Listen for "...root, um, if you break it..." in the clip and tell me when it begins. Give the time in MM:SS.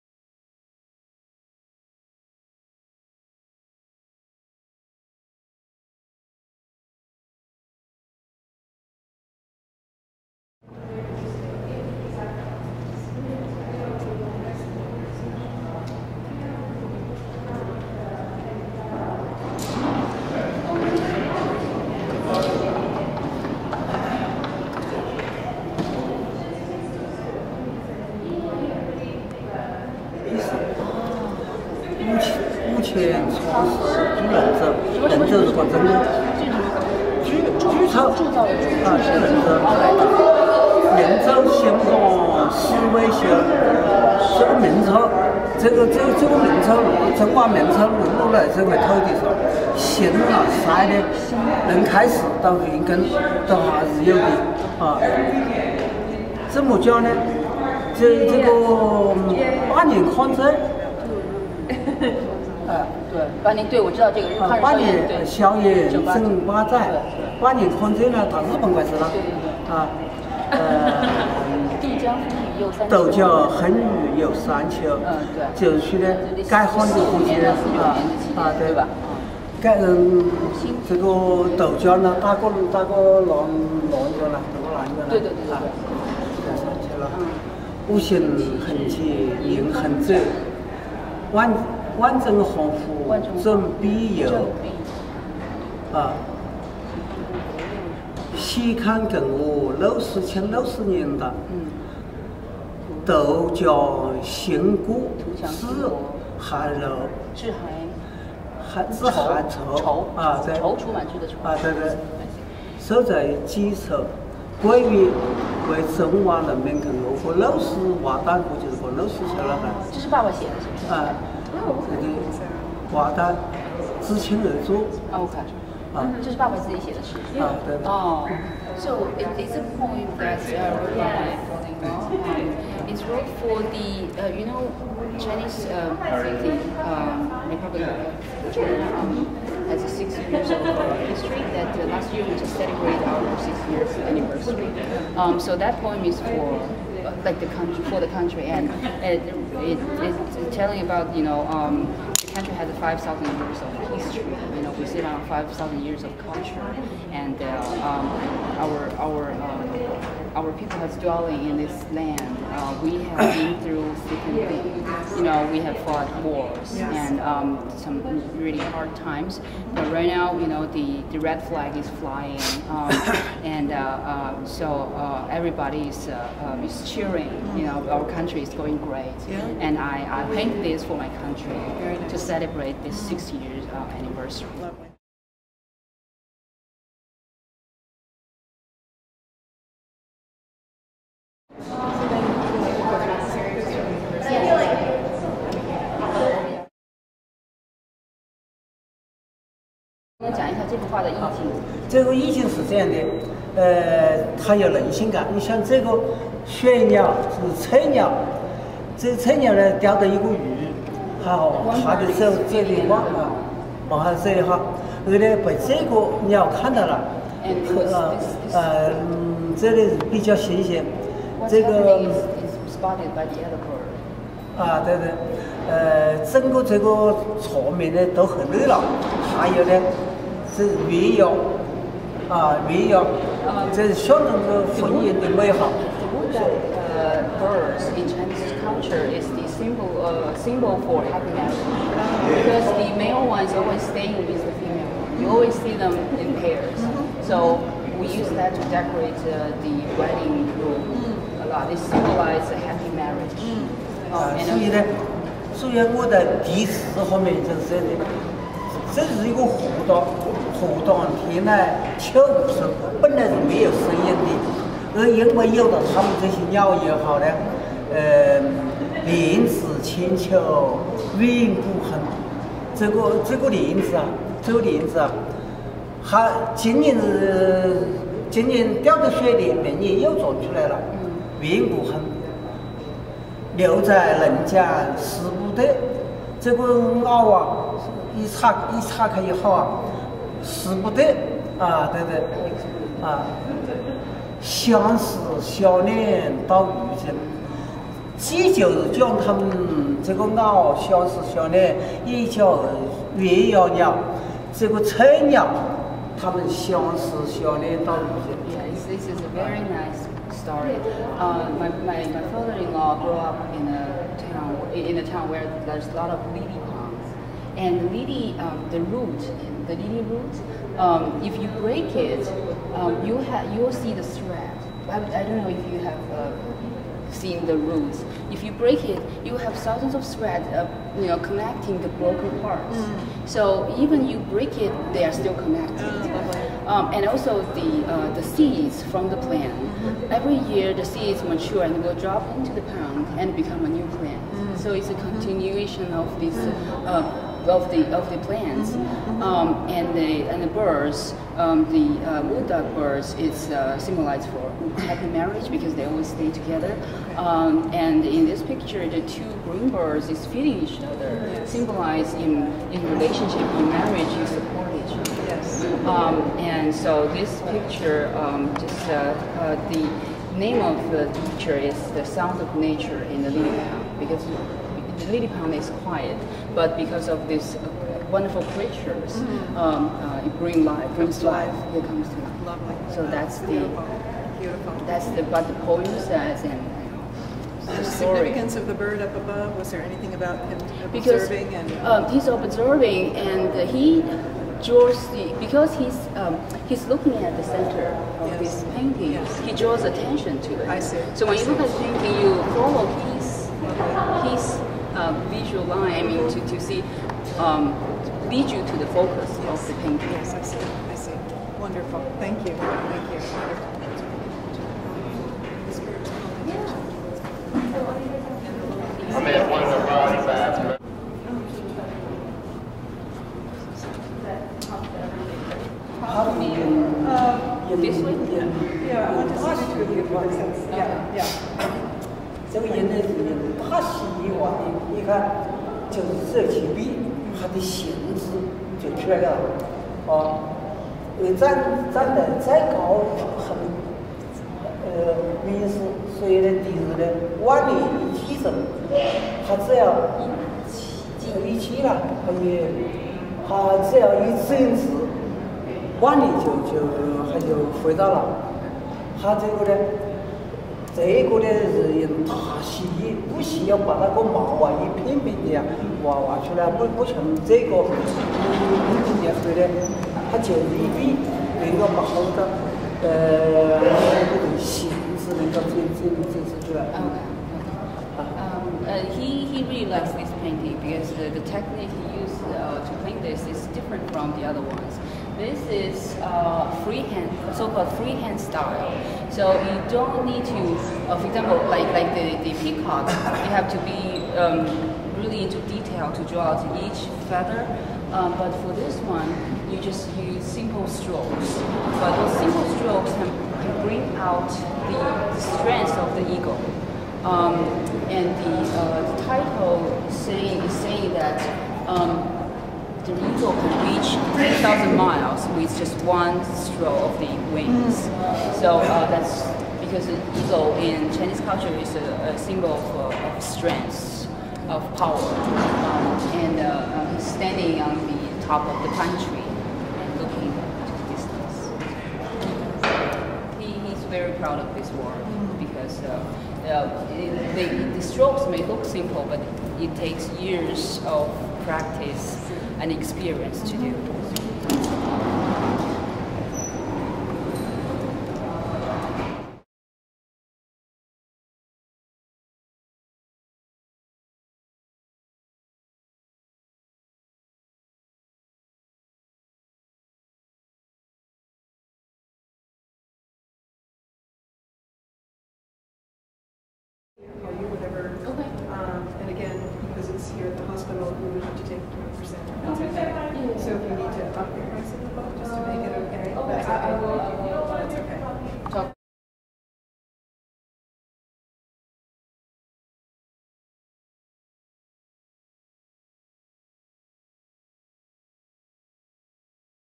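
05:20.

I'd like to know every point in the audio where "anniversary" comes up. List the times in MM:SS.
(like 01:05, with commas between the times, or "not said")
02:24, 03:03.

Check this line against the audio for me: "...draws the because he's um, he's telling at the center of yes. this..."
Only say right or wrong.
wrong.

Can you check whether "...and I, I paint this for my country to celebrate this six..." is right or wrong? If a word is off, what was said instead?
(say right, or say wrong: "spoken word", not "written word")
right.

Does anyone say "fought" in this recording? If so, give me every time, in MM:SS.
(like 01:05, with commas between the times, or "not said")
02:45.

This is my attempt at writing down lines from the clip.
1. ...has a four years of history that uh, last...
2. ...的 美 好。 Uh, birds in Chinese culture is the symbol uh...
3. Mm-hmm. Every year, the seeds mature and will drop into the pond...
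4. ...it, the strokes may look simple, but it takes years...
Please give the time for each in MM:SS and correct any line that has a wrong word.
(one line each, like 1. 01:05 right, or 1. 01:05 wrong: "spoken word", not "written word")
1. 02:19 wrong: "six", not "four"
2. 03:55 right
3. 05:39 right
4. 08:57 right.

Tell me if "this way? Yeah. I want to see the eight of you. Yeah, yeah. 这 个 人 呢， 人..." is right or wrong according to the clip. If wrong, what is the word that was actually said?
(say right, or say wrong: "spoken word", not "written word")
wrong: "two", not "eight".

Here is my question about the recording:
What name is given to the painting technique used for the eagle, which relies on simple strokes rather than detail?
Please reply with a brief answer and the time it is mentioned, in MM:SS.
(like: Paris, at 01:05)
Freehand style, at 08:07.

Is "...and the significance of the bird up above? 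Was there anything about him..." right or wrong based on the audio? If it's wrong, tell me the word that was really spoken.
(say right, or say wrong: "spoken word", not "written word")
right.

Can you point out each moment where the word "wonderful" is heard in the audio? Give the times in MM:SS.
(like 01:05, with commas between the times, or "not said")
06:18, 06:51.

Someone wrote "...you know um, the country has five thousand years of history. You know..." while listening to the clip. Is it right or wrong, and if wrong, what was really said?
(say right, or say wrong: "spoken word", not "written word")
right.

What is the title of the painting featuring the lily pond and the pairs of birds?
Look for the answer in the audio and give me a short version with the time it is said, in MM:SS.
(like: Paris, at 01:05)
The sound of nature in the living room, at 06:11.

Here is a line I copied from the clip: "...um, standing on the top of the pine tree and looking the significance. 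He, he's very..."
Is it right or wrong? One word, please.
wrong.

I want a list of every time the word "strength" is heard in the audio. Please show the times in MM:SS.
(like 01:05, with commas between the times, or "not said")
08:25, 08:43.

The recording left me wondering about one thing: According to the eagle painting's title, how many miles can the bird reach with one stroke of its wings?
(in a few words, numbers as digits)
3000.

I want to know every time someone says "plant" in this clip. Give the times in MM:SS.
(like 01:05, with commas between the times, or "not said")
05:39, 05:43, 05:48.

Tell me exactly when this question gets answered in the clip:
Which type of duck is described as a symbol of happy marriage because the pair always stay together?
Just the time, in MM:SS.
05:52.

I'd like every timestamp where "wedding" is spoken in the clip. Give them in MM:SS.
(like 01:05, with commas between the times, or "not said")
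04:09.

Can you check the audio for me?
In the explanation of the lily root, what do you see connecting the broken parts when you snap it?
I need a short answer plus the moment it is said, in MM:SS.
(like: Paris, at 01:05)
Thousands of threads, at 05:29.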